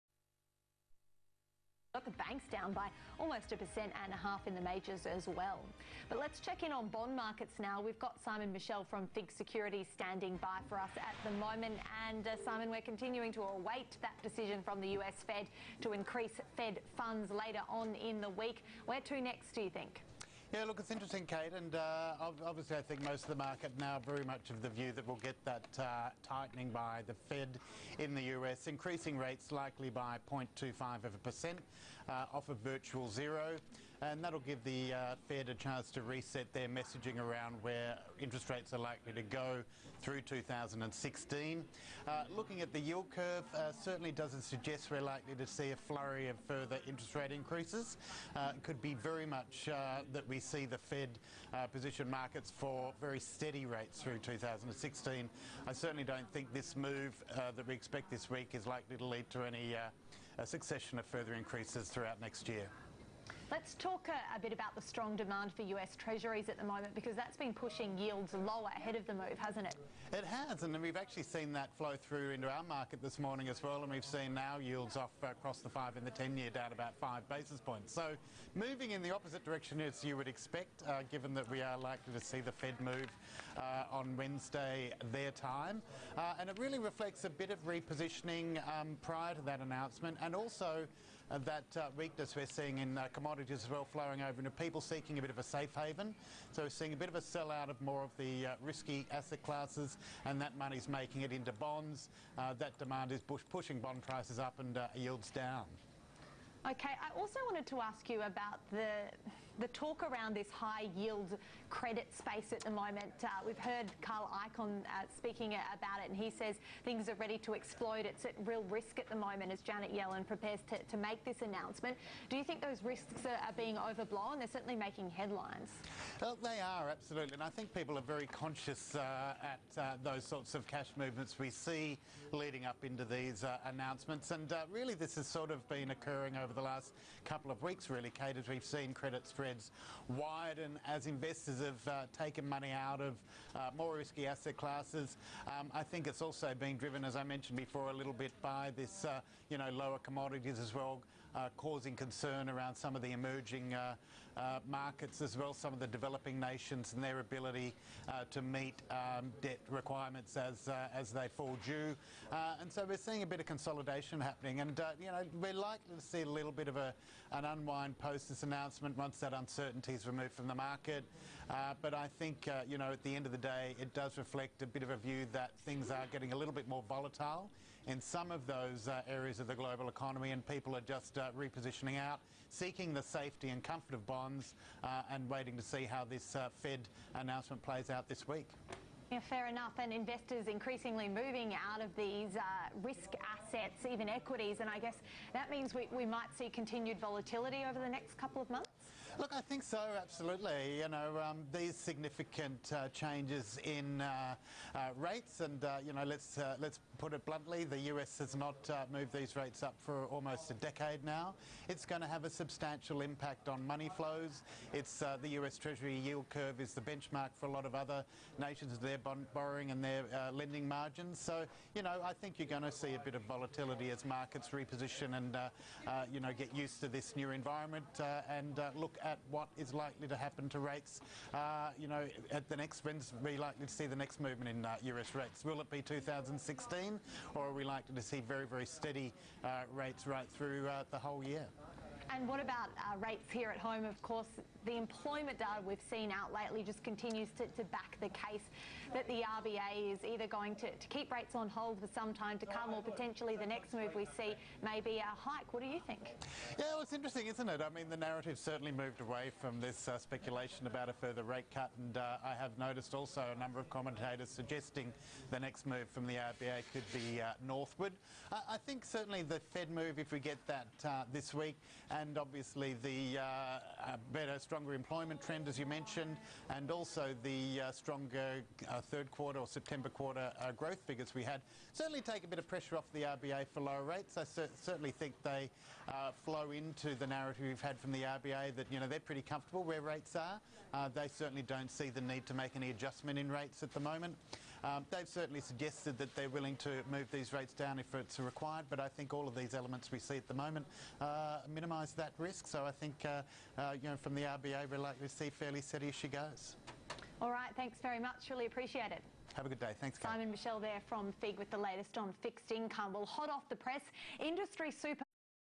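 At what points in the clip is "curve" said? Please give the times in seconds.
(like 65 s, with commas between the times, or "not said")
43 s, 216 s.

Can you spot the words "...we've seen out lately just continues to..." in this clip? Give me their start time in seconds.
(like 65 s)
245 s.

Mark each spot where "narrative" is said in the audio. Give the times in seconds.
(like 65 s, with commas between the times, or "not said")
257 s, 287 s.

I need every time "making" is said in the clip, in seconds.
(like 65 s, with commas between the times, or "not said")
100 s, 124 s.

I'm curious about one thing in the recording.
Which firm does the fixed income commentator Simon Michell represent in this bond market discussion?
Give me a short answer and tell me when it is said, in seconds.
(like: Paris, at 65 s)
FIIG Securities, at 9 s.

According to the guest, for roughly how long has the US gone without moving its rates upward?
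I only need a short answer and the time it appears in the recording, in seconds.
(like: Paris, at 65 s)
almost a decade, at 210 s.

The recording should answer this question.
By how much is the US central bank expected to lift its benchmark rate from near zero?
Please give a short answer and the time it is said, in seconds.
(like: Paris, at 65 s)
0.25%, at 30 s.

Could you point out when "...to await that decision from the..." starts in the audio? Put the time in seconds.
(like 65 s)
13 s.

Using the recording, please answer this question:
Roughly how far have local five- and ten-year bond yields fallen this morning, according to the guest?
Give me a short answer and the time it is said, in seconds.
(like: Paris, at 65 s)
5 basis points, at 76 s.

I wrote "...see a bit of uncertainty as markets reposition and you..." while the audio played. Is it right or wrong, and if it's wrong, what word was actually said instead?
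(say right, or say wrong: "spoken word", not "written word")
wrong: "volatility", not "uncertainty".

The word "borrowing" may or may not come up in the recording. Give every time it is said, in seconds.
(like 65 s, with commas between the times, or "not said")
219 s.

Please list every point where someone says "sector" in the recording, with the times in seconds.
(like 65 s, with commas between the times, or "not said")
not said.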